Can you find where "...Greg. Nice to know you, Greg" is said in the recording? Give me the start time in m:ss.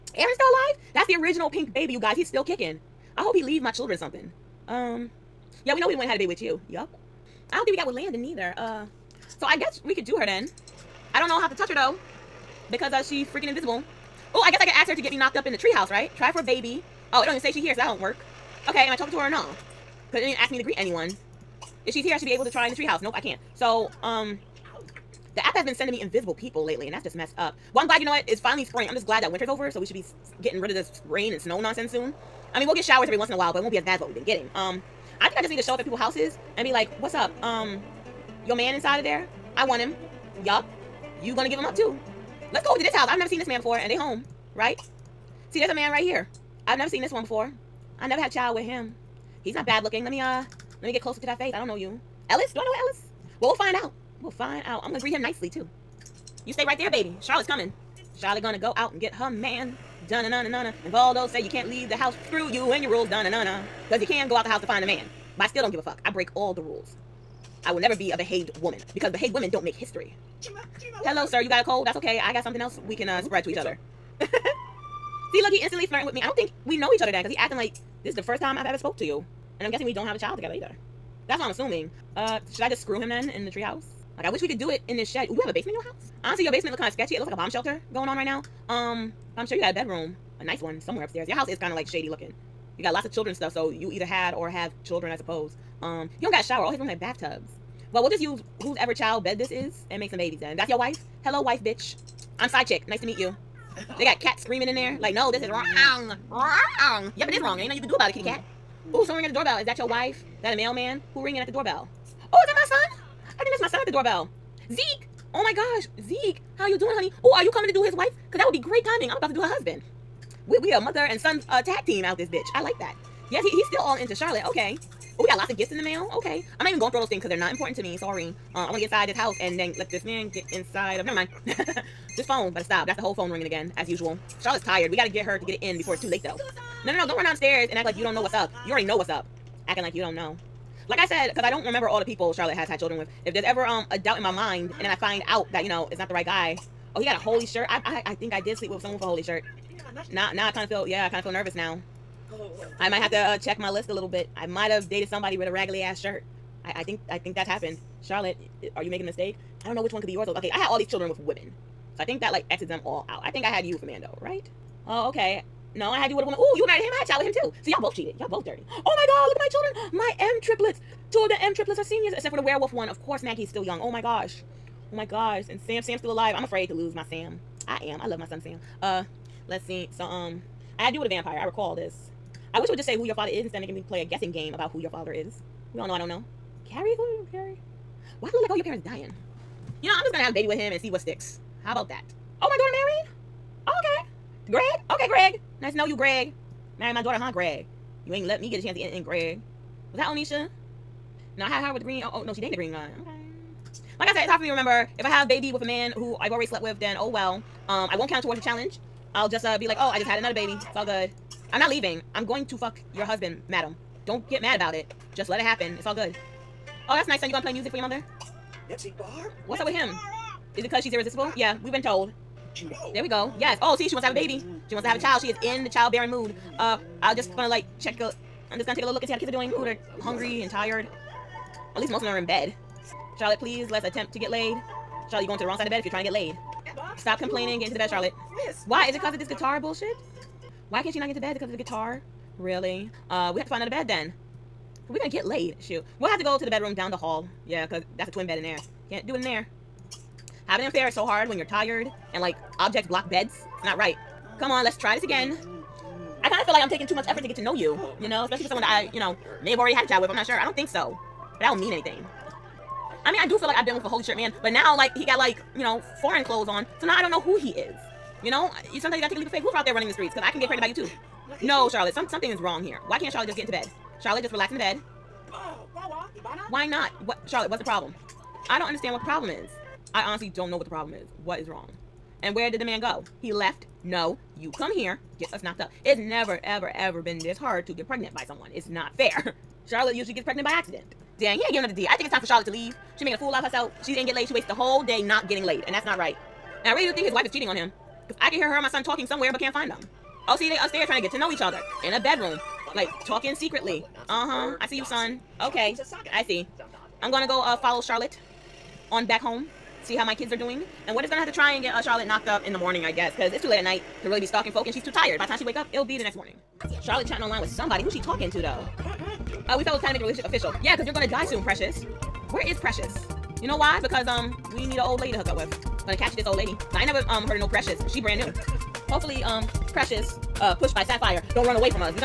3:15.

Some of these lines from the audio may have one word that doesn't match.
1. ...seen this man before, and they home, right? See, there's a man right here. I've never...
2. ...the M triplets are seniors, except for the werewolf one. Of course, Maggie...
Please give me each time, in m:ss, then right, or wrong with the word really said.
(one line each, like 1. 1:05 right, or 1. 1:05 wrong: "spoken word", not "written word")
1. 0:43 right
2. 2:51 right.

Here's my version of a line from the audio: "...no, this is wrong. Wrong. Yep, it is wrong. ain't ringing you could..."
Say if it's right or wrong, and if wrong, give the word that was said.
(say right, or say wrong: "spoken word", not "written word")
wrong: "nothing", not "ringing".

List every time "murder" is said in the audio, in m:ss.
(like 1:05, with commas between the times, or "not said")
not said.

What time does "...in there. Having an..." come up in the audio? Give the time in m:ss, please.
4:09.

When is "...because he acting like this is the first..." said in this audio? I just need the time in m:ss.
1:17.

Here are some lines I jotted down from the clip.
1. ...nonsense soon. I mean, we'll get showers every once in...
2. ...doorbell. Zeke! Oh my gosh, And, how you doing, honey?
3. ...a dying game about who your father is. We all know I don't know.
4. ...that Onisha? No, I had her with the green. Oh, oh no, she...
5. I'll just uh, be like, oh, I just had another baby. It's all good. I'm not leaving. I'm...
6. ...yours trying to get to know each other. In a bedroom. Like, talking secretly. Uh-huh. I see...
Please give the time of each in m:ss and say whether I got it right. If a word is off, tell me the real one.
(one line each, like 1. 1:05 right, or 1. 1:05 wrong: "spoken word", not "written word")
1. 0:31 right
2. 1:53 wrong: "Zeke", not "And"
3. 3:04 wrong: "guessing", not "dying"
4. 3:19 right
5. 3:29 right
6. 5:00 wrong: "upstairs", not "yours".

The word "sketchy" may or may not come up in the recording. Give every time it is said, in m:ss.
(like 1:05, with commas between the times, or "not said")
1:26.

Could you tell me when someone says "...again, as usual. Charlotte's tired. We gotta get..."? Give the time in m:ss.
2:13.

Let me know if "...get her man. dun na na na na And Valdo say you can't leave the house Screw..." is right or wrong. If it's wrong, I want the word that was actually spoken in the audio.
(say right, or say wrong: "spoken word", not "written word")
right.